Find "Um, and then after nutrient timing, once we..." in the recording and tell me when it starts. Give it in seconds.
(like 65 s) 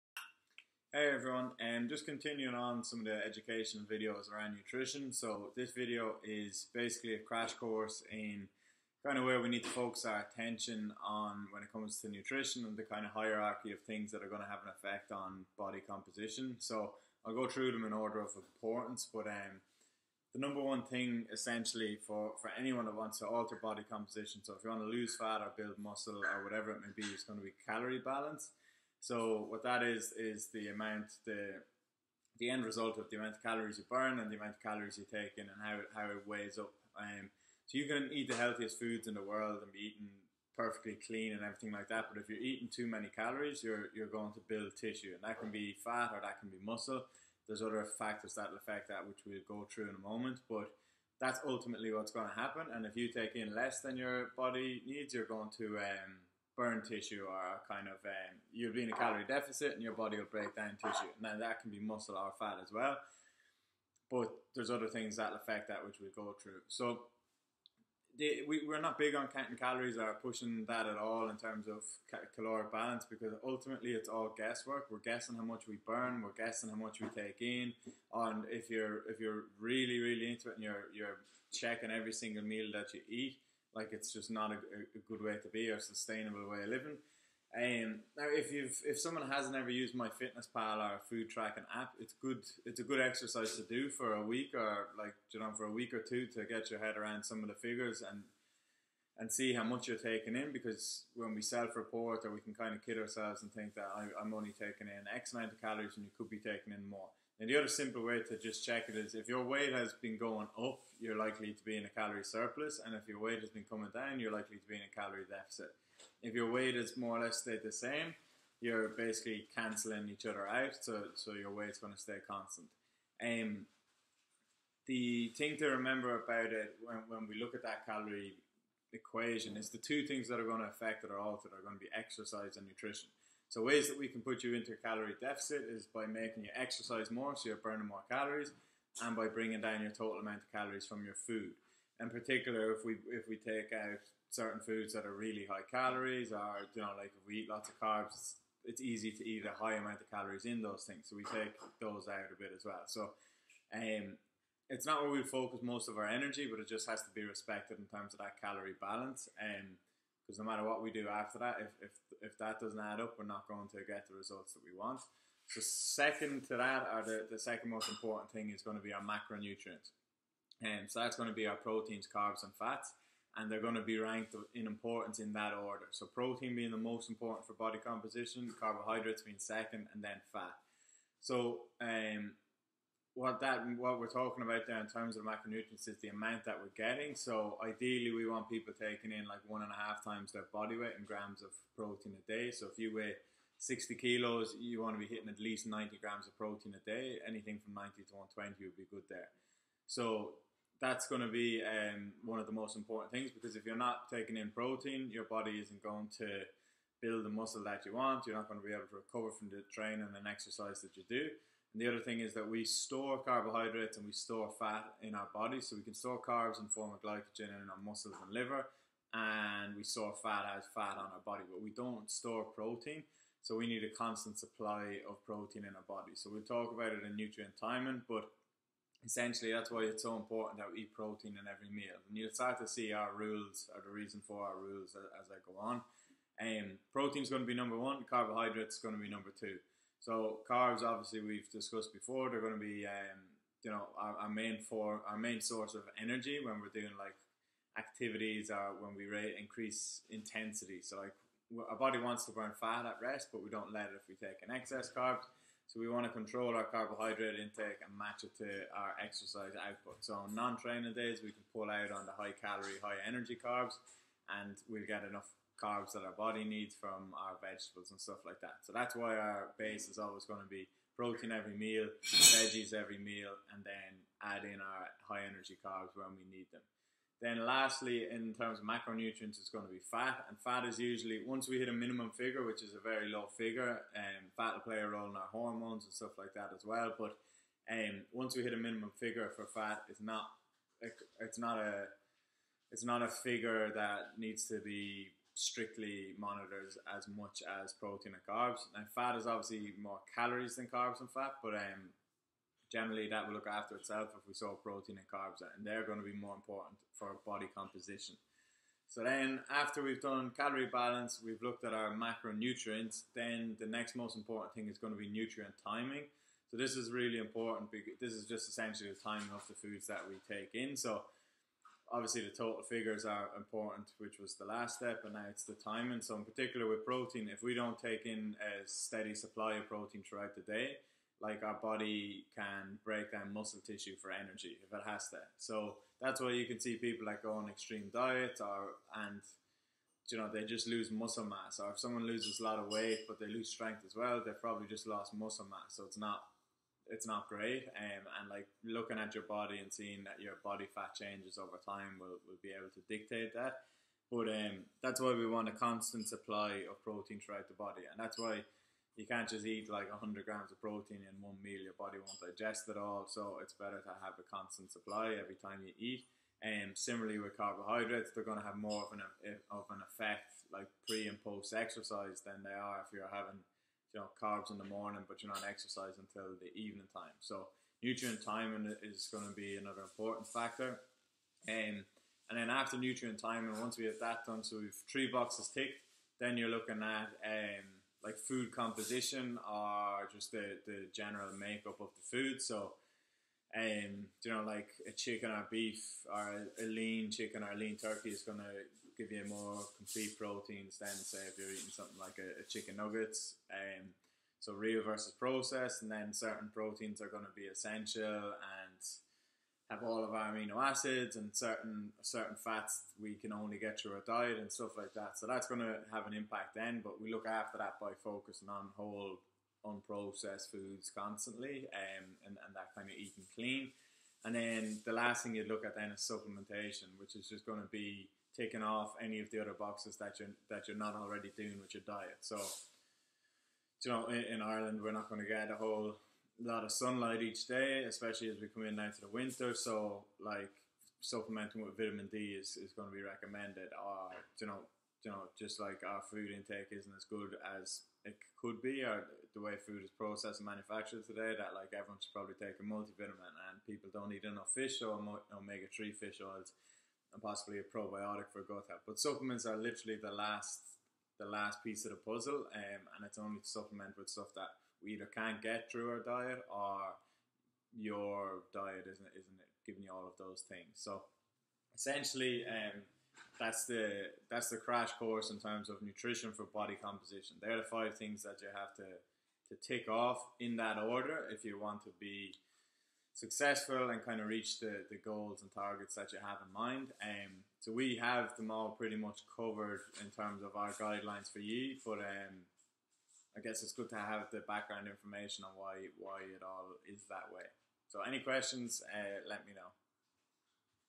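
381 s.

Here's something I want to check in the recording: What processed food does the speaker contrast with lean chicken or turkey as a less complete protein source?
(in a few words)
Chicken nuggets.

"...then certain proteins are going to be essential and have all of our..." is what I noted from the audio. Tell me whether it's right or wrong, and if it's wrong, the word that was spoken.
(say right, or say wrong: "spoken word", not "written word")
right.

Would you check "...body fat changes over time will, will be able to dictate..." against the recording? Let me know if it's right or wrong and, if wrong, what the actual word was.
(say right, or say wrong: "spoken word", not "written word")
right.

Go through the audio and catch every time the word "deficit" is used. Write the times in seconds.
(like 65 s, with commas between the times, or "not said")
59 s, 115 s, 135 s.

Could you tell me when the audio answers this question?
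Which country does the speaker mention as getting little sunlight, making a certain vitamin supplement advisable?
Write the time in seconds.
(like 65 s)
434 s.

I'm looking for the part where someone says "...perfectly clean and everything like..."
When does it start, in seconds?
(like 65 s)
40 s.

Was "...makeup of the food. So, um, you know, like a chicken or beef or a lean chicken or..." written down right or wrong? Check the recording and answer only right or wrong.
right.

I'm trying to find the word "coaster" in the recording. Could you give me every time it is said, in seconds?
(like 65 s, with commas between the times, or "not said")
not said.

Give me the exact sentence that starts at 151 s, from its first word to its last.
So we take those out a bit as well.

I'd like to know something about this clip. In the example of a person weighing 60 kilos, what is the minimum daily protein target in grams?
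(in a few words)
90.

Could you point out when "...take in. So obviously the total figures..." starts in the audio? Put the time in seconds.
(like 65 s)
320 s.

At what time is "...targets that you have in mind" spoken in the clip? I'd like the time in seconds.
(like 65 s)
485 s.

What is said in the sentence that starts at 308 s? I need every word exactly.
So then, after we've done calorie balance, we've looked at our macronutrients.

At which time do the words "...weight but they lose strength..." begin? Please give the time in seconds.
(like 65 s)
342 s.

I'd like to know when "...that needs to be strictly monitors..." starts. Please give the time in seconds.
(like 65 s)
293 s.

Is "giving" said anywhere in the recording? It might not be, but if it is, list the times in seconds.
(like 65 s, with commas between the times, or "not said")
469 s.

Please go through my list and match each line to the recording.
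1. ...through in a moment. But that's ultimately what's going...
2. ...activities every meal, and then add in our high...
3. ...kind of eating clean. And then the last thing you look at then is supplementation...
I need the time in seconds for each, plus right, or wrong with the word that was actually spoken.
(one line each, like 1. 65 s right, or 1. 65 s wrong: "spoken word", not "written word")
1. 49 s right
2. 272 s wrong: "veggies", not "activities"
3. 422 s right.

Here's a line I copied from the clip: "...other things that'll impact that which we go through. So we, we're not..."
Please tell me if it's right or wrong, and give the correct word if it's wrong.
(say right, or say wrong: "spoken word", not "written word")
wrong: "affect", not "impact".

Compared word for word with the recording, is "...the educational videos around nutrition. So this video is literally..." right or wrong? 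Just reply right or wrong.
wrong.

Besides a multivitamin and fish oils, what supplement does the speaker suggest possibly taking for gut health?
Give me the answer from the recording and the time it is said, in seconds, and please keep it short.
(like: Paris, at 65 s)
A probiotic, at 457 s.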